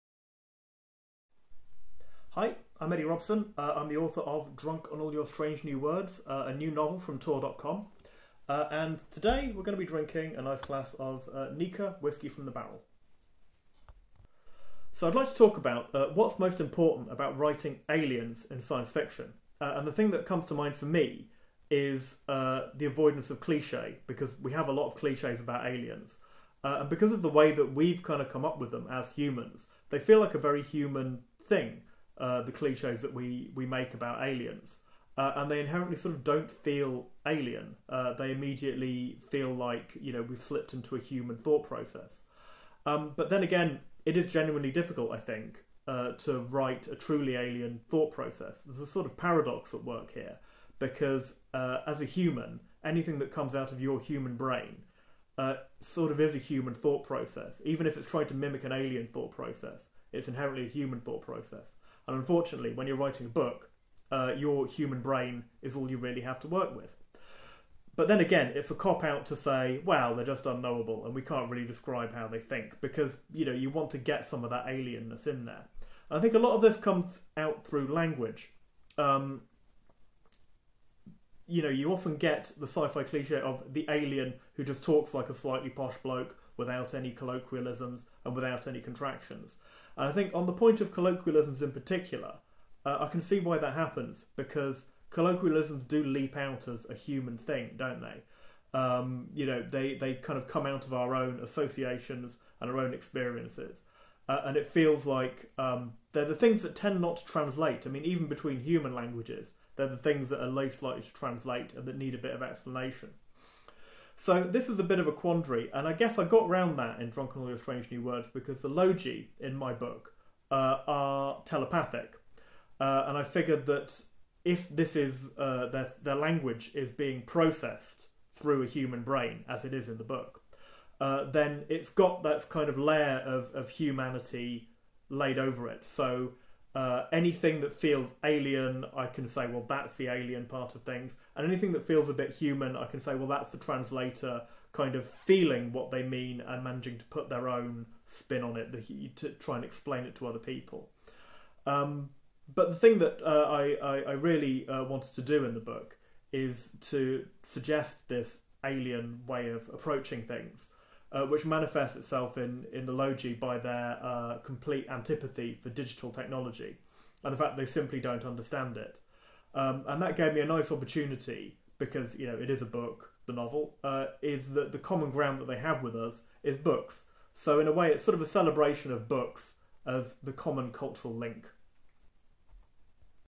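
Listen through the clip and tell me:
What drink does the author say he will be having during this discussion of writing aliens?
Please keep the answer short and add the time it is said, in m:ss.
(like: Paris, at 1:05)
Nikka whiskey, at 0:11.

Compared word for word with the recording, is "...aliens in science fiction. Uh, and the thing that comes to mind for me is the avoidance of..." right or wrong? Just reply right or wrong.
right.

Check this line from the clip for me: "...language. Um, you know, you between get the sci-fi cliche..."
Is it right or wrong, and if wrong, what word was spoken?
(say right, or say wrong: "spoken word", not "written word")
wrong: "often", not "between".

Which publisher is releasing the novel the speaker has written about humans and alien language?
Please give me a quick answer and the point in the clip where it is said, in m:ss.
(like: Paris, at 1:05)
Tor.com, at 0:07.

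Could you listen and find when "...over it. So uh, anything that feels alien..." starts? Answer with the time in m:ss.
2:15.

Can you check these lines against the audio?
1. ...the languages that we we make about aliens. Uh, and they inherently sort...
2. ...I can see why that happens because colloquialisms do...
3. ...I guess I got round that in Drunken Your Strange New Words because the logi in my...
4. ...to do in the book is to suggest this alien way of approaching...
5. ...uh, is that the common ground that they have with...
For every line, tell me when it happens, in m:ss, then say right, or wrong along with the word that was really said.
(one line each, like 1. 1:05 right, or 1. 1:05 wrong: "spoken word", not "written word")
1. 0:32 wrong: "cliches", not "languages"
2. 1:33 right
3. 1:55 right
4. 2:35 right
5. 2:53 right.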